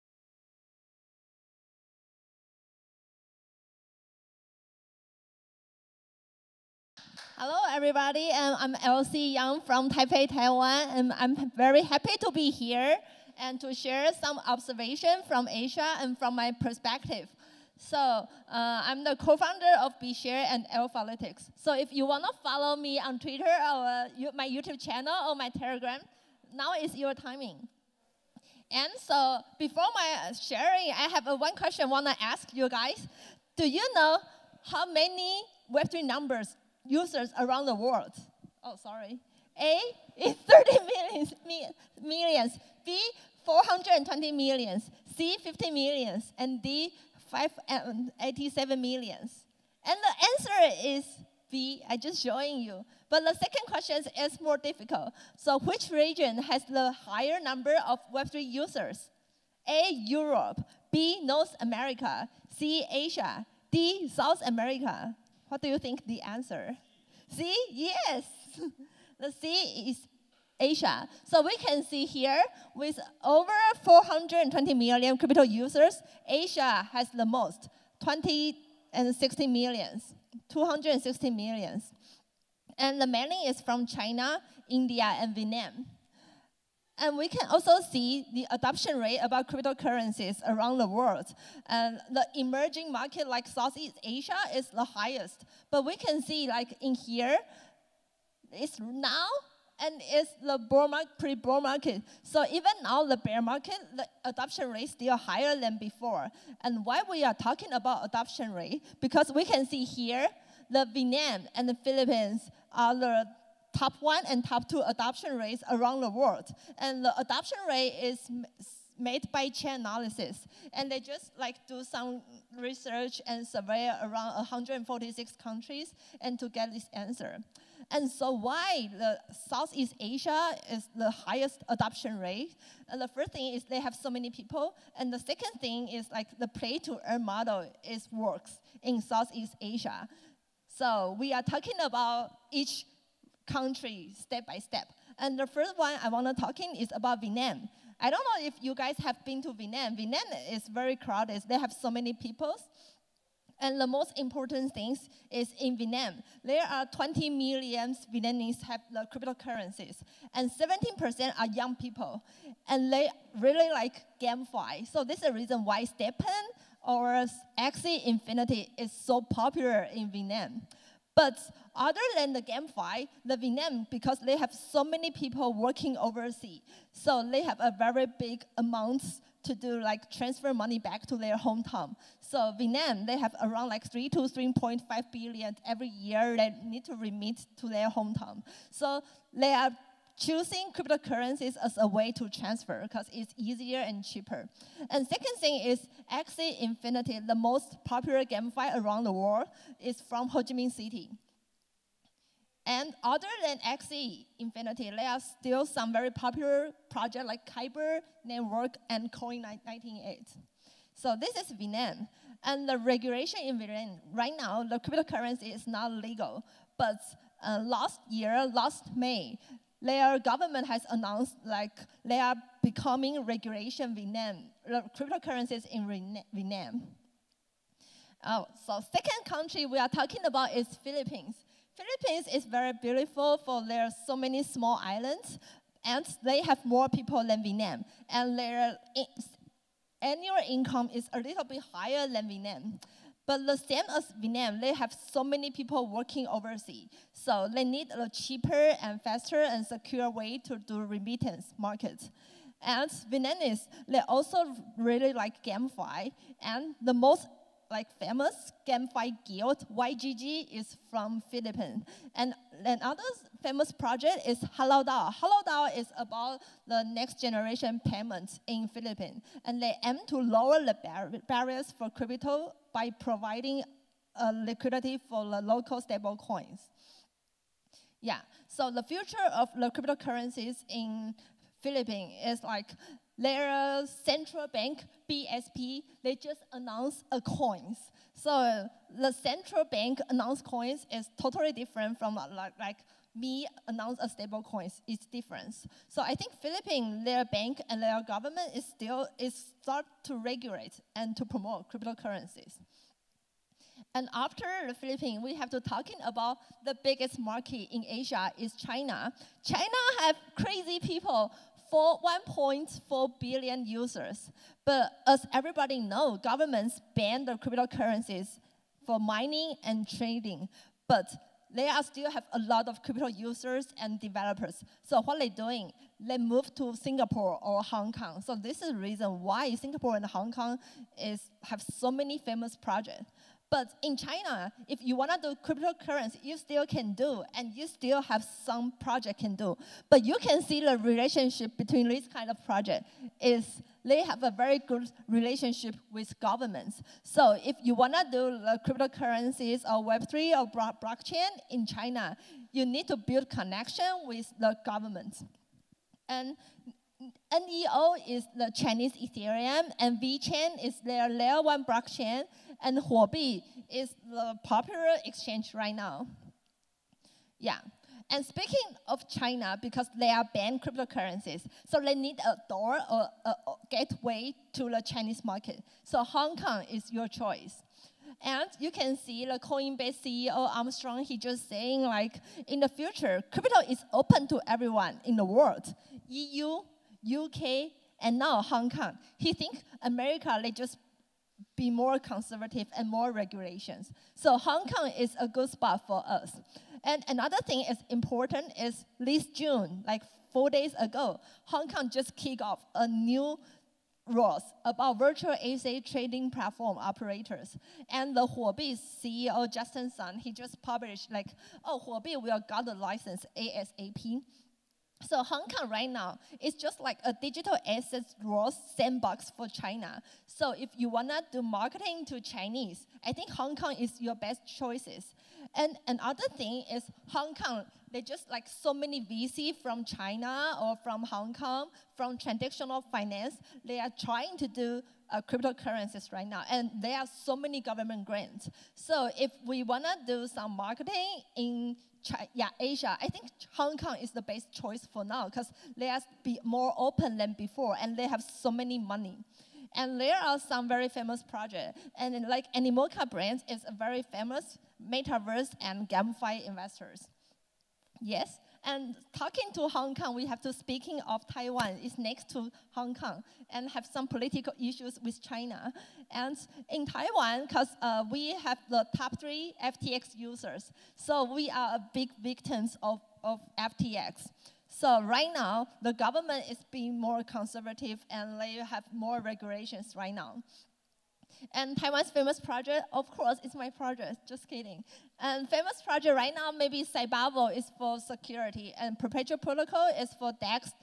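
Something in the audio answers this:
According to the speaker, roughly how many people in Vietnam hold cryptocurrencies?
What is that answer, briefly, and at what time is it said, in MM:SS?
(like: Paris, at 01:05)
20 million, at 02:36.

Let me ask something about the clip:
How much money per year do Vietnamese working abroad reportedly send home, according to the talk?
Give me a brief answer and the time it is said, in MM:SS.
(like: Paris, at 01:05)
3 to 3.5 billion, at 03:03.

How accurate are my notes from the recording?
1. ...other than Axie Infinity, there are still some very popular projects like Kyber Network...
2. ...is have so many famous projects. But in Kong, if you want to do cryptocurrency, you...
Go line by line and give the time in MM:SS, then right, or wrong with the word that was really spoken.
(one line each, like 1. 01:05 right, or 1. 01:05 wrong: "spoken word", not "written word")
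1. 03:23 right
2. 05:31 wrong: "China", not "Kong".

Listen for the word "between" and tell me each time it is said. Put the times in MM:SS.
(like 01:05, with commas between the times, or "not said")
05:41.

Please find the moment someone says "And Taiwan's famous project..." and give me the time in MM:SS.
08:01.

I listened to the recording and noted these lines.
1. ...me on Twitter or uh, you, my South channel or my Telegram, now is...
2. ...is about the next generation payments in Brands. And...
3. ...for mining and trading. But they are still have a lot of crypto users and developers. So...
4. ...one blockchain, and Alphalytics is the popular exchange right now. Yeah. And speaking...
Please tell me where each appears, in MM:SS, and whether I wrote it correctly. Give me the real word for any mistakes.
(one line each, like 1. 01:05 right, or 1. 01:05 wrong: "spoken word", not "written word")
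1. 00:22 wrong: "YouTube", not "South"
2. 04:25 wrong: "Philippines", not "Brands"
3. 05:18 right
4. 06:01 wrong: "Huobi", not "Alphalytics".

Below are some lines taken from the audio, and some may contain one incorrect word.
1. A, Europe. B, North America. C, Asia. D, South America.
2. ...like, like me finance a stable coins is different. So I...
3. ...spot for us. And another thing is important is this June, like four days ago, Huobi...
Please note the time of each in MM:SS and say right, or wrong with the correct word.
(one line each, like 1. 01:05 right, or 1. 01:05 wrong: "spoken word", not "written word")
1. 00:59 right
2. 04:52 wrong: "announce", not "finance"
3. 06:35 wrong: "Hong", not "Huobi".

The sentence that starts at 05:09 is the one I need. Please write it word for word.
China have crazy people for 1.4 billion users.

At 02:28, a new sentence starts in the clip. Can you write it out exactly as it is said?
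I don't know if you guys have been to Vietnam.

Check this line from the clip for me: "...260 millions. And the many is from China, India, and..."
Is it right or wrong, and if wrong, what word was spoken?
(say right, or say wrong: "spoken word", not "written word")
right.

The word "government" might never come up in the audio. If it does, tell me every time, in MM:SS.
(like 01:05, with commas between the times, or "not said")
03:40, 04:58, 05:16, 05:46, 05:54, 07:17, 07:55.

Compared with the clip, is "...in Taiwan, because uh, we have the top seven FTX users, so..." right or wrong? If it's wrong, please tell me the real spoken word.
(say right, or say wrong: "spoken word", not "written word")
wrong: "three", not "seven".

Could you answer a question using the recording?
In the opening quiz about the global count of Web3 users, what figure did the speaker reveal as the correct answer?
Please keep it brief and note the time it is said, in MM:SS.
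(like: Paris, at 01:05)
420 million, at 00:42.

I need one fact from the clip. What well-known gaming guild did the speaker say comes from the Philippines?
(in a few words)
YGG.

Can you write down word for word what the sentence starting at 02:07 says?
And so why the Southeast Asia is the highest adoption rate?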